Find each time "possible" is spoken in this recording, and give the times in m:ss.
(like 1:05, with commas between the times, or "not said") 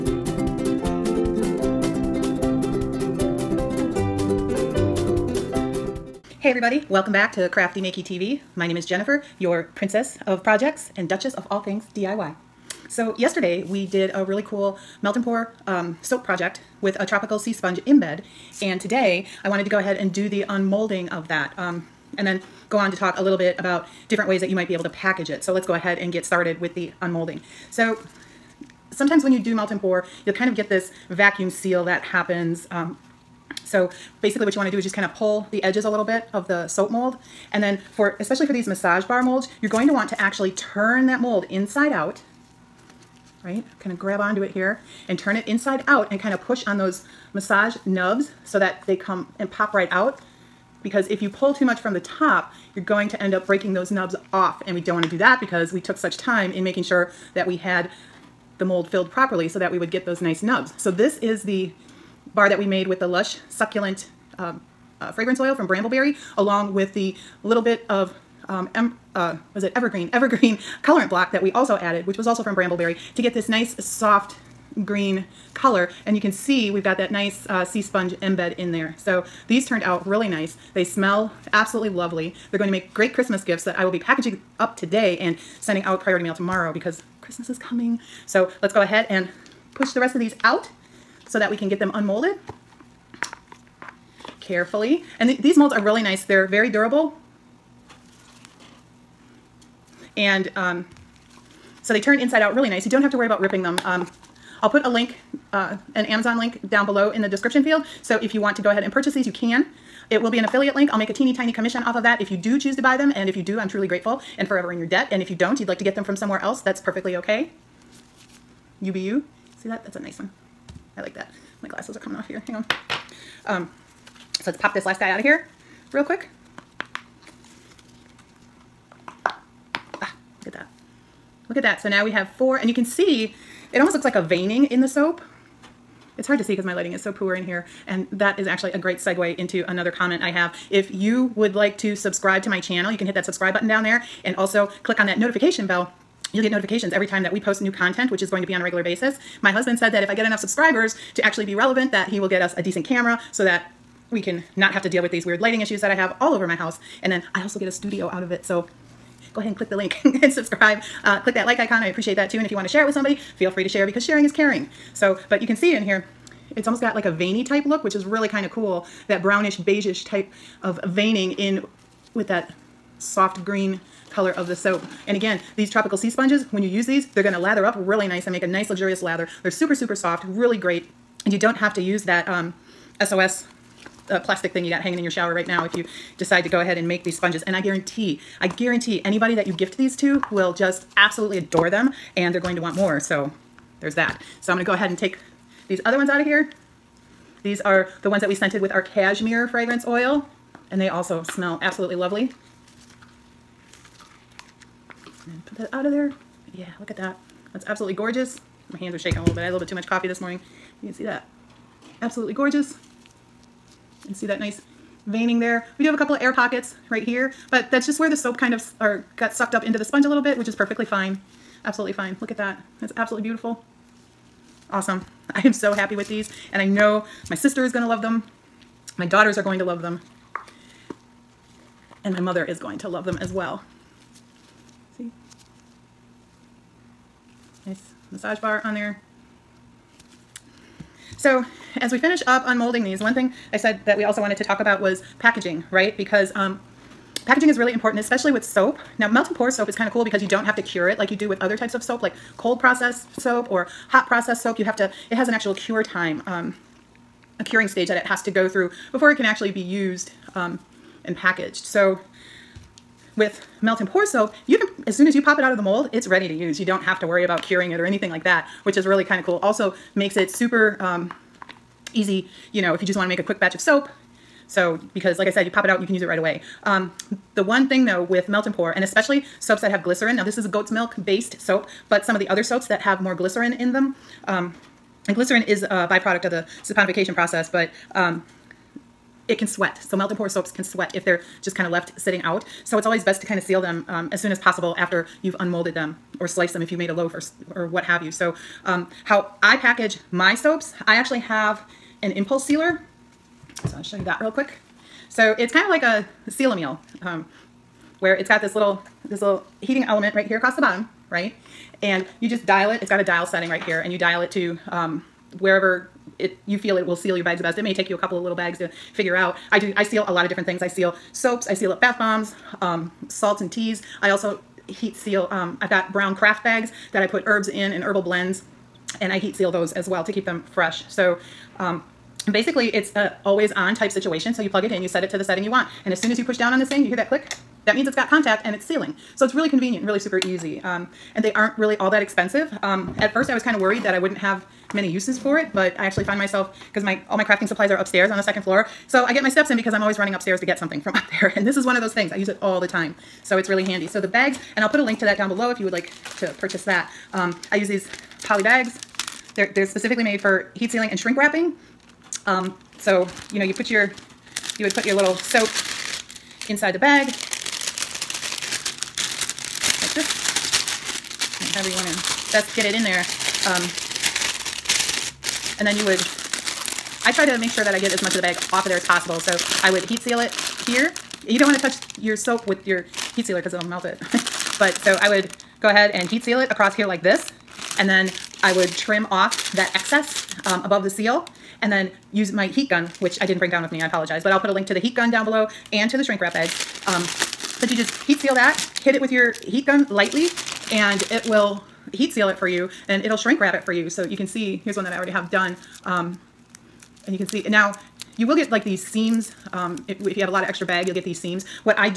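4:54, 6:18.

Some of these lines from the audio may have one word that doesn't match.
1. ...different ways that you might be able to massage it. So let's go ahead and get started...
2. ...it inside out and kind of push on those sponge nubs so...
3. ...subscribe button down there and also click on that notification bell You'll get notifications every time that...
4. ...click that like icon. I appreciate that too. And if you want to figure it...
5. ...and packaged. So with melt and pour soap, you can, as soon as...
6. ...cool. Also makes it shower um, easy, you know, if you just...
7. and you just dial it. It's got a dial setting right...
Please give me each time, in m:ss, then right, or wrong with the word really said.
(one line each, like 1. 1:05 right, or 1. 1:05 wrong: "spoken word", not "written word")
1. 0:24 wrong: "package", not "massage"
2. 0:45 wrong: "massage", not "sponge"
3. 2:23 right
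4. 2:41 wrong: "share", not "figure"
5. 4:21 right
6. 4:29 wrong: "super", not "shower"
7. 5:11 right.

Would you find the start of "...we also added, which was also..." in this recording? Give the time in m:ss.
1:11.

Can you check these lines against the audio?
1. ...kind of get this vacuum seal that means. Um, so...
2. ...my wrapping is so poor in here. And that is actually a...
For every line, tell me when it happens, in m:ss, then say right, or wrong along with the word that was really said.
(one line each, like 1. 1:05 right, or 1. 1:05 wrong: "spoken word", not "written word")
1. 0:30 wrong: "happens", not "means"
2. 2:16 wrong: "lighting", not "wrapping".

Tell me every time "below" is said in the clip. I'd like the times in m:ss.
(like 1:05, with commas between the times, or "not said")
1:46, 5:55, 6:35.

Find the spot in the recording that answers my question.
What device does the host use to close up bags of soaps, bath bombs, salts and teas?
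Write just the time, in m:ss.
5:02.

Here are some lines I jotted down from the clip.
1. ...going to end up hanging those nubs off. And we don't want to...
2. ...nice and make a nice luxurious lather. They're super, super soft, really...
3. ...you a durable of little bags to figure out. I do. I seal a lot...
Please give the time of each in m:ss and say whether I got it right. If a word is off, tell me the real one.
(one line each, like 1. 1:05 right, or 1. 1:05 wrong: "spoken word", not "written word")
1. 0:52 wrong: "breaking", not "hanging"
2. 2:58 right
3. 5:17 wrong: "couple", not "durable".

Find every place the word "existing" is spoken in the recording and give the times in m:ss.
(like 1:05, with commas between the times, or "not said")
not said.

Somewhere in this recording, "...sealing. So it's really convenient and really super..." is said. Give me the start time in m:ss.
5:38.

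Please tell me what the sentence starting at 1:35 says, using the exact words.
And th these molds are really nice.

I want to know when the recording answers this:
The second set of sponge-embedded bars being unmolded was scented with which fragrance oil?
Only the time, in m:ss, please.
3:18.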